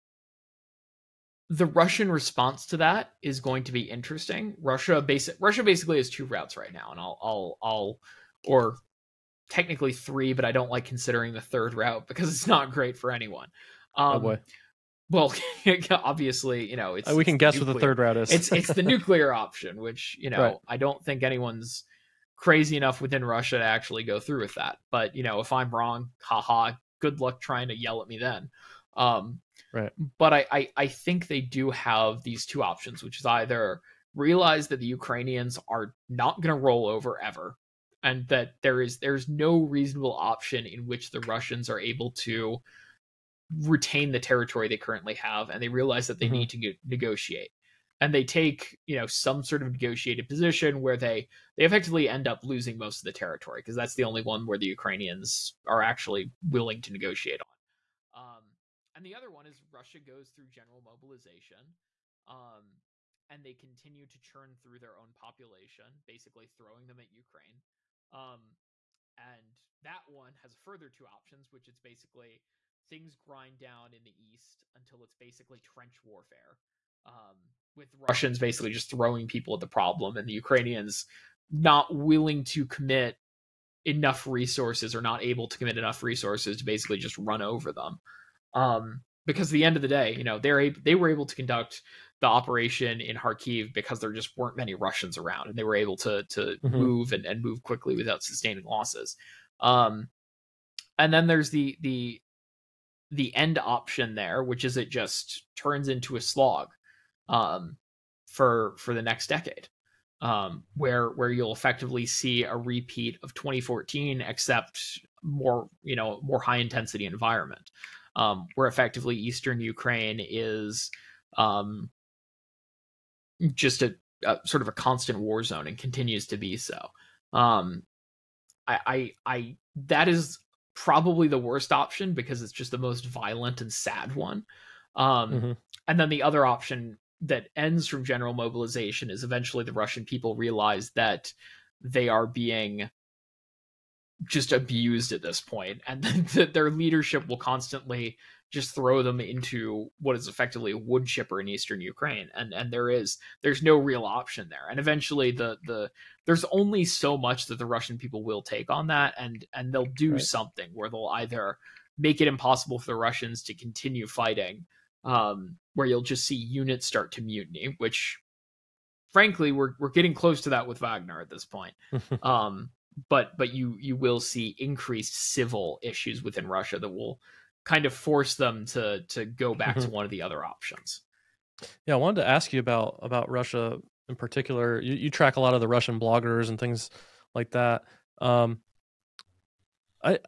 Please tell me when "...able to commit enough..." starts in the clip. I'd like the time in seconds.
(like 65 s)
85 s.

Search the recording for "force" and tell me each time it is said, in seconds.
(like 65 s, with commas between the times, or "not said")
177 s.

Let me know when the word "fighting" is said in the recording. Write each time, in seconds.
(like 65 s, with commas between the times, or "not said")
164 s.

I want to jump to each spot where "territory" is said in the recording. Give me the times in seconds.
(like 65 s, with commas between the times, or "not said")
44 s, 53 s.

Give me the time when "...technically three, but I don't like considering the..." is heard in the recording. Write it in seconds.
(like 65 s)
9 s.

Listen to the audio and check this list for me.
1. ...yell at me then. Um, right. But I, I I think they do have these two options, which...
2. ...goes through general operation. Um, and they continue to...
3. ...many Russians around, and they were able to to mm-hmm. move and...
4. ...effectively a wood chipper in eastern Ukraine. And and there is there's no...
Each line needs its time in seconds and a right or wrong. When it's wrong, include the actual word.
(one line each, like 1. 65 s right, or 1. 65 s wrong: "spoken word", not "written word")
1. 27 s right
2. 59 s wrong: "mobilization", not "operation"
3. 94 s right
4. 150 s right.